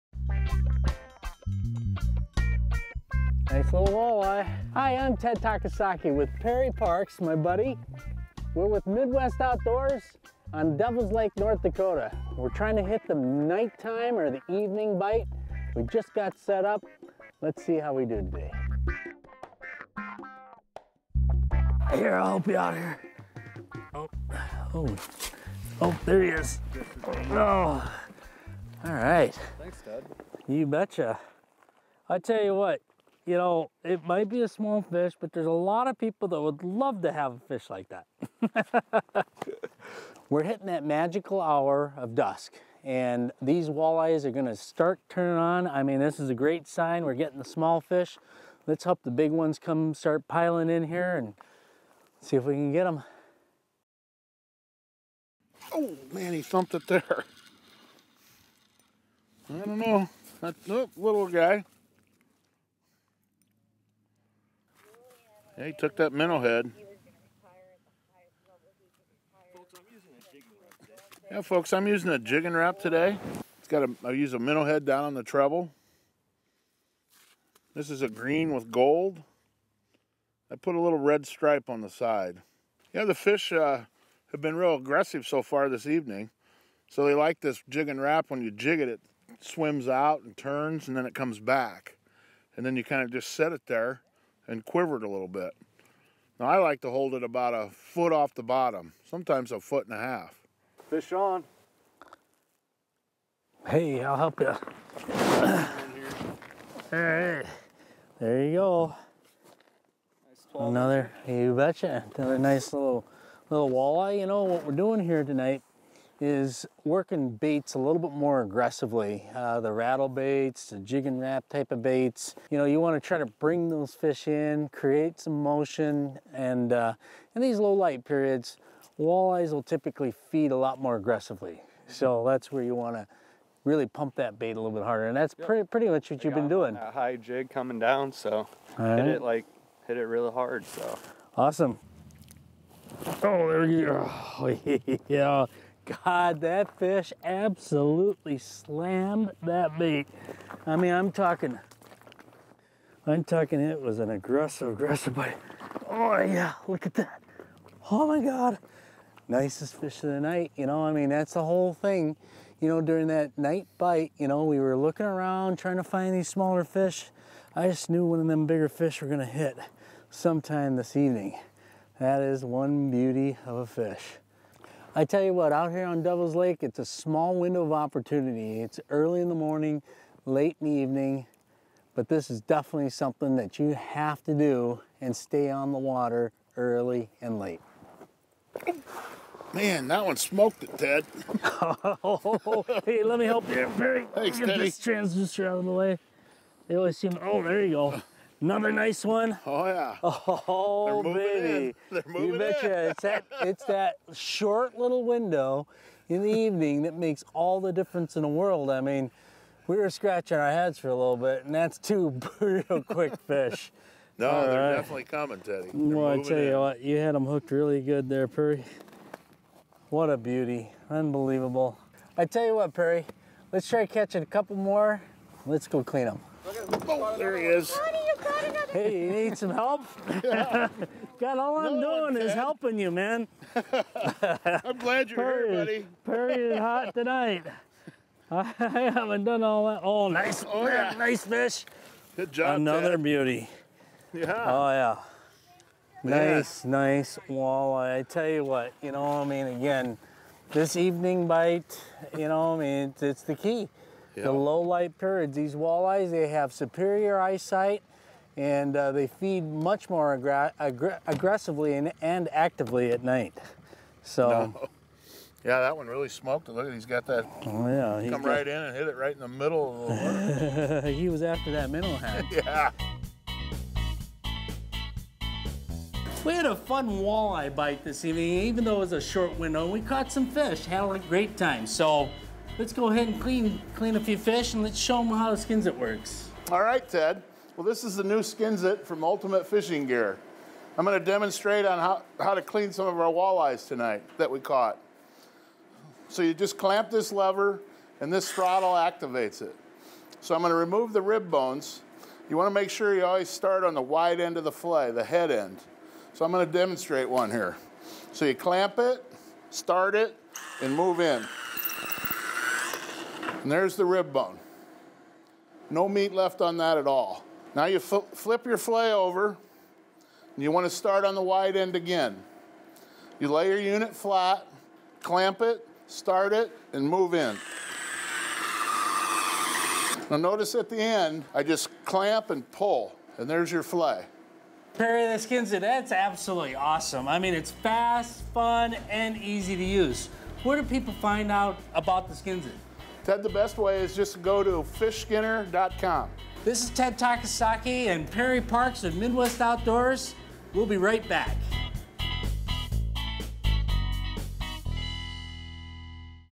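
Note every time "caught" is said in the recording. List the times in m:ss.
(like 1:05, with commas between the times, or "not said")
4:39, 4:54.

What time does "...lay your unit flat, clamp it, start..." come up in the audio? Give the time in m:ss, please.
5:23.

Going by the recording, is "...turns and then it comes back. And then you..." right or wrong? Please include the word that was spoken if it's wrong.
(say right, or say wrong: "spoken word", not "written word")
right.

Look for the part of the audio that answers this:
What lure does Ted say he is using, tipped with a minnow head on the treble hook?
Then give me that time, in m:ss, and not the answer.
1:12.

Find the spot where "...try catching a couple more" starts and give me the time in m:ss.
3:43.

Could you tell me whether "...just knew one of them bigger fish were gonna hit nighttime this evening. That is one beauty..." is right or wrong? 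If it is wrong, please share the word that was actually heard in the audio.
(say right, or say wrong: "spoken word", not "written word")
wrong: "sometime", not "nighttime".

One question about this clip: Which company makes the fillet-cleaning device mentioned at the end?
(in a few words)
Ultimate Fishing Gear.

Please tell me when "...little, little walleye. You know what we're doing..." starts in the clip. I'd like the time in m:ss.
1:52.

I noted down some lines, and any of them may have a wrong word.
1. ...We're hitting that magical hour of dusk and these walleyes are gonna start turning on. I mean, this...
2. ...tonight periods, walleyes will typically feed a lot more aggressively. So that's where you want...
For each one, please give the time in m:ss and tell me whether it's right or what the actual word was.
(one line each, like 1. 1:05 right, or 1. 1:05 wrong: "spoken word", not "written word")
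1. 0:40 right
2. 2:07 wrong: "light", not "tonight".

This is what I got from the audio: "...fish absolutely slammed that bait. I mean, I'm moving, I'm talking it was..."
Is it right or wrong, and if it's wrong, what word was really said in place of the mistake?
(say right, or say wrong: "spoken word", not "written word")
wrong: "talking", not "moving".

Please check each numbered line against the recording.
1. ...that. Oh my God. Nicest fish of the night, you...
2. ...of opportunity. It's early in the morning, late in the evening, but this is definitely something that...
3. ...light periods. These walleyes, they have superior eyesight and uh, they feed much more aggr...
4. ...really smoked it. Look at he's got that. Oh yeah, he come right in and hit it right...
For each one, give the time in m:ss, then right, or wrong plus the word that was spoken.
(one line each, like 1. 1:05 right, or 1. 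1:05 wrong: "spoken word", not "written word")
1. 2:36 right
2. 2:57 right
3. 4:14 right
4. 4:25 right.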